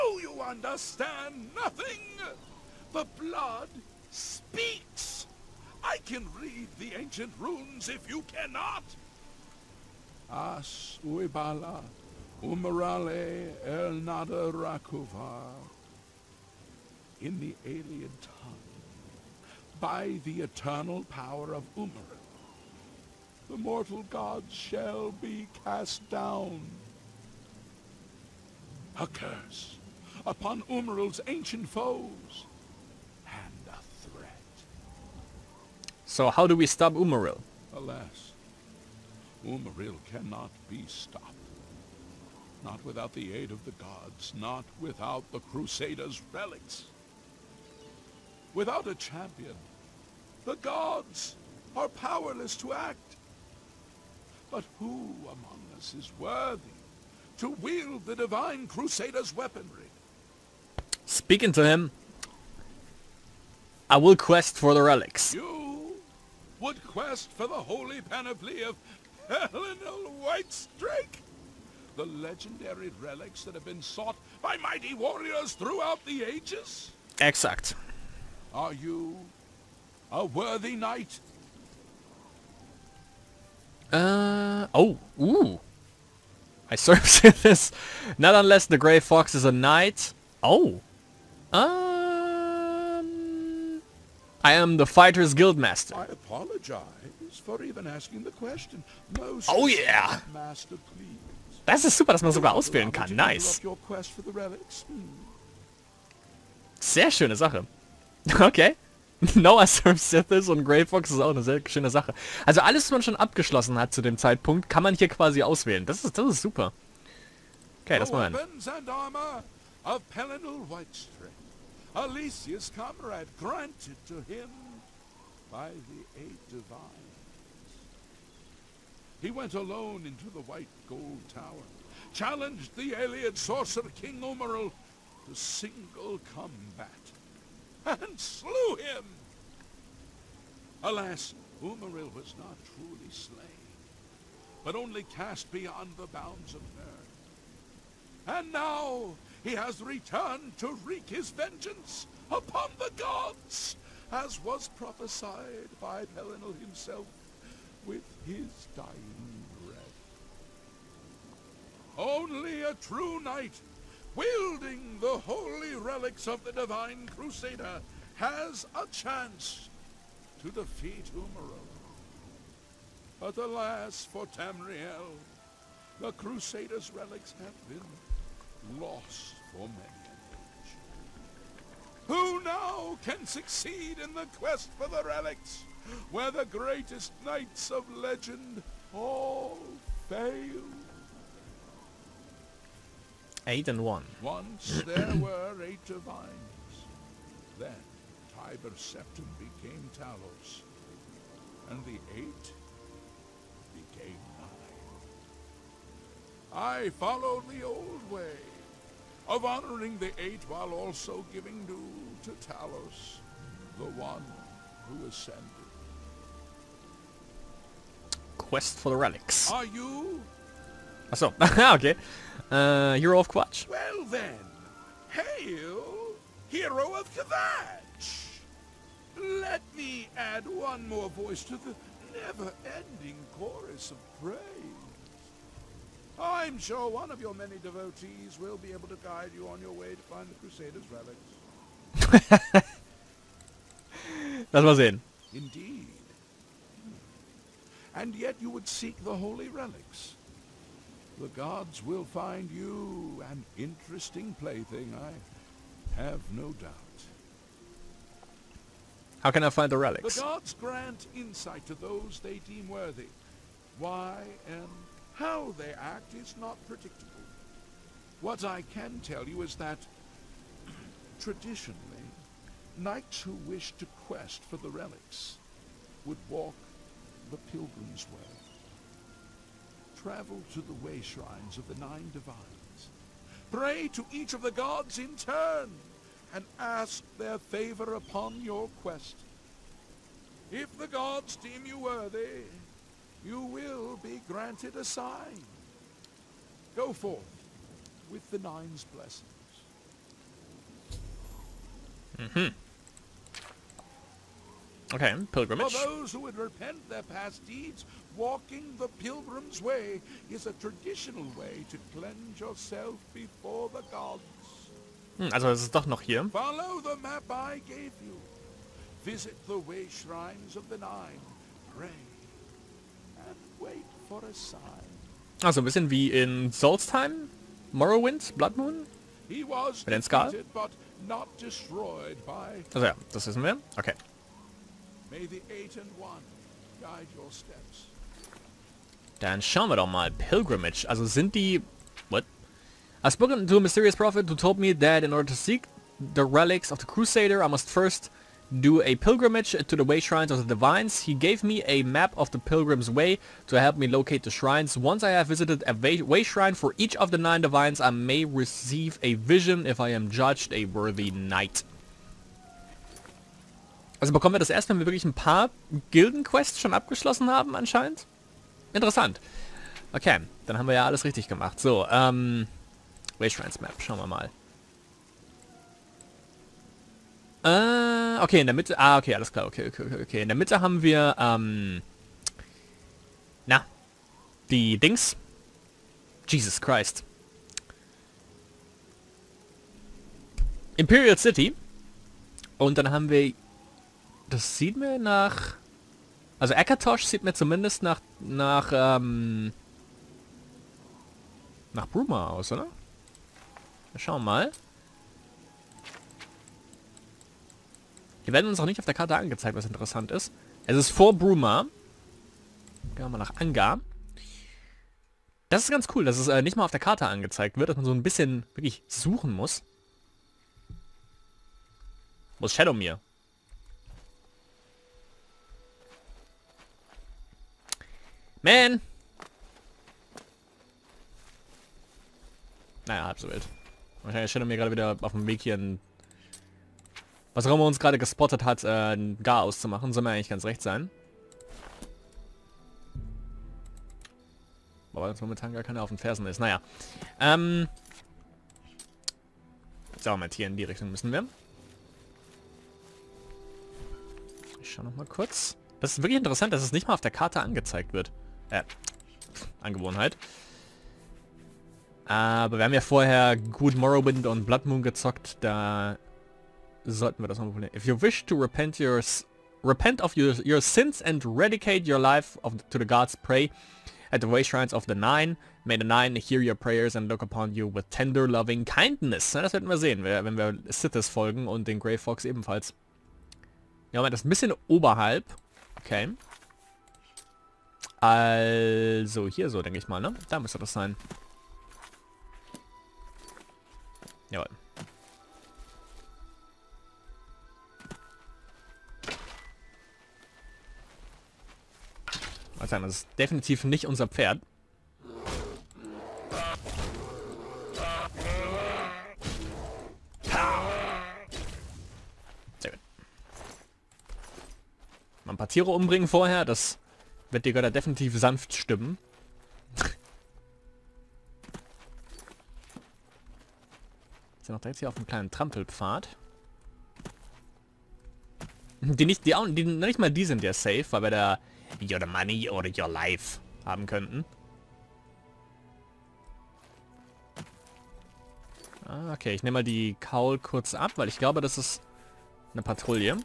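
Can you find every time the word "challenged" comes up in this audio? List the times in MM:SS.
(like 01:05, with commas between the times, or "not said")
02:12.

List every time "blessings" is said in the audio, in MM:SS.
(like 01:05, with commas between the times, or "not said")
04:58.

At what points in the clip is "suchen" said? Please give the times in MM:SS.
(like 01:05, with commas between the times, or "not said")
06:58.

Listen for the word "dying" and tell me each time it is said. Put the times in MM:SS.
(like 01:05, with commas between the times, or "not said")
02:38.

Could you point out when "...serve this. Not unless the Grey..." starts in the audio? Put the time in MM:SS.
01:26.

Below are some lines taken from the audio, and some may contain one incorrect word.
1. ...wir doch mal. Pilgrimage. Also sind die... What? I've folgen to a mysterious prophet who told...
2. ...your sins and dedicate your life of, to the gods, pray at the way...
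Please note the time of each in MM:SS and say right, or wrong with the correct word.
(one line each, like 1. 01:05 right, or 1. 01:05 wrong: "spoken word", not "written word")
1. 05:39 wrong: "spoken", not "folgen"
2. 07:50 right.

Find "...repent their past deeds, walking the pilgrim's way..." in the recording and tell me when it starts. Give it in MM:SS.
05:06.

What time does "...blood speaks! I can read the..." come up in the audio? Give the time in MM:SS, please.
00:03.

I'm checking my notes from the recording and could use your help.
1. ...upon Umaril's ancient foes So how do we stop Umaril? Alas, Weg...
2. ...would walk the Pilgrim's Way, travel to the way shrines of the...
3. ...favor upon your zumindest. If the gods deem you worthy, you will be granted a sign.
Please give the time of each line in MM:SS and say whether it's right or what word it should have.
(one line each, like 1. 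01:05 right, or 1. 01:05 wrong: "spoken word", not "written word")
1. 00:30 wrong: "Umaril", not "Weg"
2. 04:36 right
3. 04:47 wrong: "quest", not "zumindest".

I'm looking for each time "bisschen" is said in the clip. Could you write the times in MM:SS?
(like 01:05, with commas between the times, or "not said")
05:25, 06:58, 08:04.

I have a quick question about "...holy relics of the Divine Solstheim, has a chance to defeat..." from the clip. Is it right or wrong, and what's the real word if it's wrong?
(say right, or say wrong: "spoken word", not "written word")
wrong: "Crusader", not "Solstheim".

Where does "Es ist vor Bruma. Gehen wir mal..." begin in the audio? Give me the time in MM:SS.
06:50.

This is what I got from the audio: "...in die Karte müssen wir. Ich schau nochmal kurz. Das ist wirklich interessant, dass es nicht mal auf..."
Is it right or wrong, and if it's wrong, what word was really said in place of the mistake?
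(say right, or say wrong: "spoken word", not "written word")
wrong: "Richtung", not "Karte".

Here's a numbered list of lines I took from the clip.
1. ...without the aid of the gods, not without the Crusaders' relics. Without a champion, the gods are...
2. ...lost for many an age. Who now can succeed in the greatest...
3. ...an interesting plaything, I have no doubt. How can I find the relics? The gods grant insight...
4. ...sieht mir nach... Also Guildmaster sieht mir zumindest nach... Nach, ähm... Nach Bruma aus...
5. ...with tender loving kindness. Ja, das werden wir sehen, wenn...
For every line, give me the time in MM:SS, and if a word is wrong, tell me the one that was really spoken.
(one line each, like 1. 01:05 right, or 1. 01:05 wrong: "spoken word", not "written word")
1. 00:42 right
2. 02:58 wrong: "quest", not "greatest"
3. 04:13 right
4. 06:34 wrong: "Akatosh", not "Guildmaster"
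5. 07:57 right.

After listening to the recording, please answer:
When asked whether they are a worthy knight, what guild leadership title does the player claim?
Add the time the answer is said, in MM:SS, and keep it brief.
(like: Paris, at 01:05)
Fighter's Guildmaster, at 01:34.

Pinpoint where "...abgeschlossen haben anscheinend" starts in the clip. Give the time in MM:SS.
06:06.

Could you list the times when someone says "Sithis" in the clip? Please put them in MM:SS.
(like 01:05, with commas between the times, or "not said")
01:50, 08:00.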